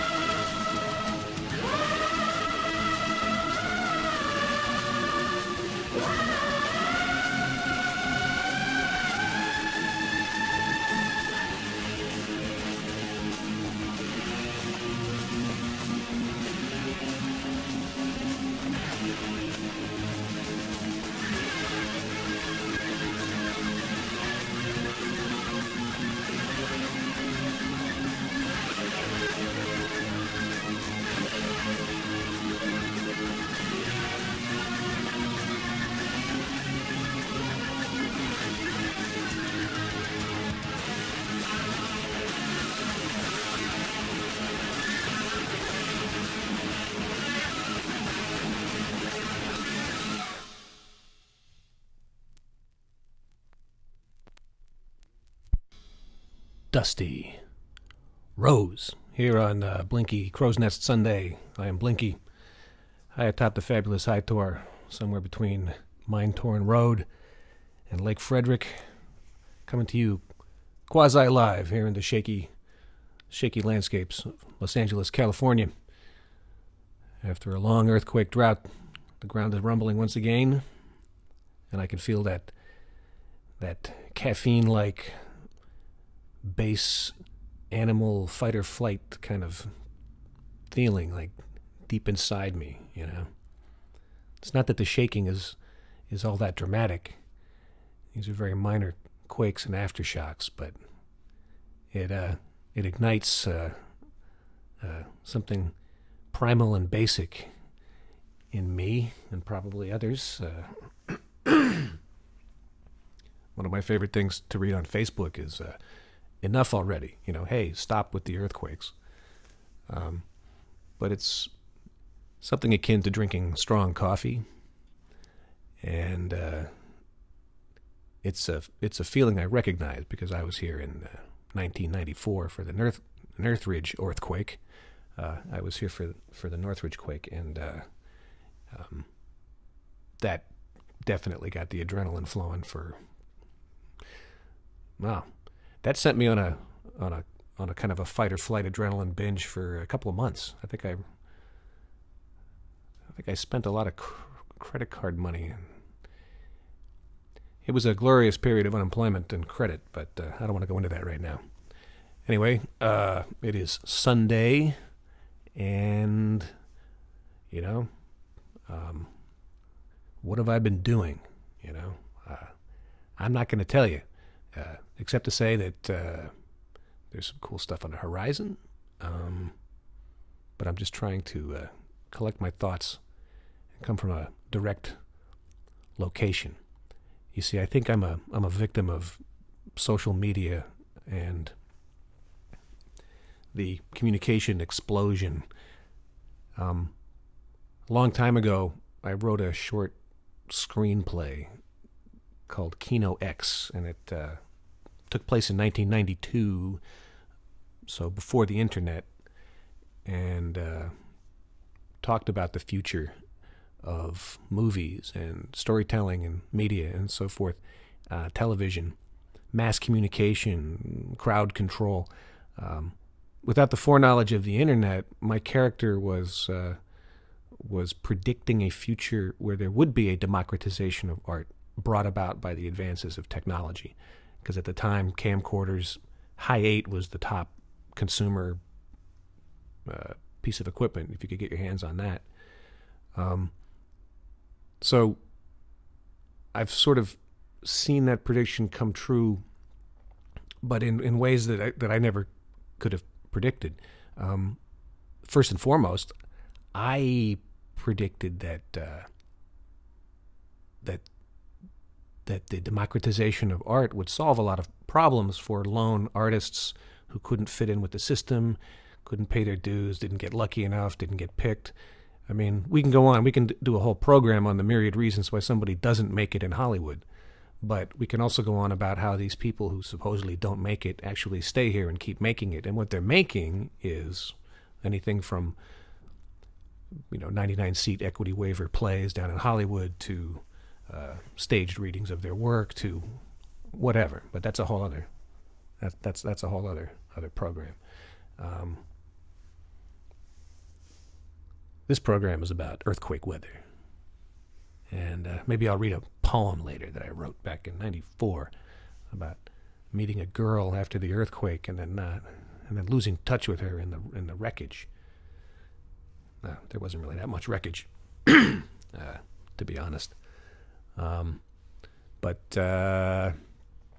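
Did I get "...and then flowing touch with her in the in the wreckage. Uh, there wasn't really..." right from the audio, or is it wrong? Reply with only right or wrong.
wrong.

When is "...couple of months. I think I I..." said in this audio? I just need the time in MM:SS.
02:29.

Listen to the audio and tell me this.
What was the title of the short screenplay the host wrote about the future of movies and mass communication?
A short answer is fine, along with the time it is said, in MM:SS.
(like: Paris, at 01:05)
Kino X, at 03:22.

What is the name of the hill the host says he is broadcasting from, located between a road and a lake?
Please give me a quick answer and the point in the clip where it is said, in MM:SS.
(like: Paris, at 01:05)
High Tor, at 01:04.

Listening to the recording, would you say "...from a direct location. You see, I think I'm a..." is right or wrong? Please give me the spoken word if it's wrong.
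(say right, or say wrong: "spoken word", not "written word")
right.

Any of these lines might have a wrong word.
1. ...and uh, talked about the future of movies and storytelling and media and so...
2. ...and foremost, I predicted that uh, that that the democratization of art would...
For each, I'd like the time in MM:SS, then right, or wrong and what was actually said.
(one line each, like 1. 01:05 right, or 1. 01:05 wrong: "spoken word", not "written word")
1. 03:30 right
2. 04:15 right.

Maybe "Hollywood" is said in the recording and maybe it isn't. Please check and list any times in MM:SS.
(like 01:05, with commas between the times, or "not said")
04:36, 04:49.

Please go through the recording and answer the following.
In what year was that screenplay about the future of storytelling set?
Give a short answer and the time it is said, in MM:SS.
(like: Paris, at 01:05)
1992, at 03:25.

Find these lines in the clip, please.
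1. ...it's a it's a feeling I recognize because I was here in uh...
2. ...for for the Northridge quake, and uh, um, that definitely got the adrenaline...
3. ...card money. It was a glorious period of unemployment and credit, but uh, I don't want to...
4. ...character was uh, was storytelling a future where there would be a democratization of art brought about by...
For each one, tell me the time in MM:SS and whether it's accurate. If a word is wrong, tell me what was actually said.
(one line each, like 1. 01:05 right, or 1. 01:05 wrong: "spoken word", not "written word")
1. 02:08 right
2. 02:15 right
3. 02:34 right
4. 03:45 wrong: "predicting", not "storytelling".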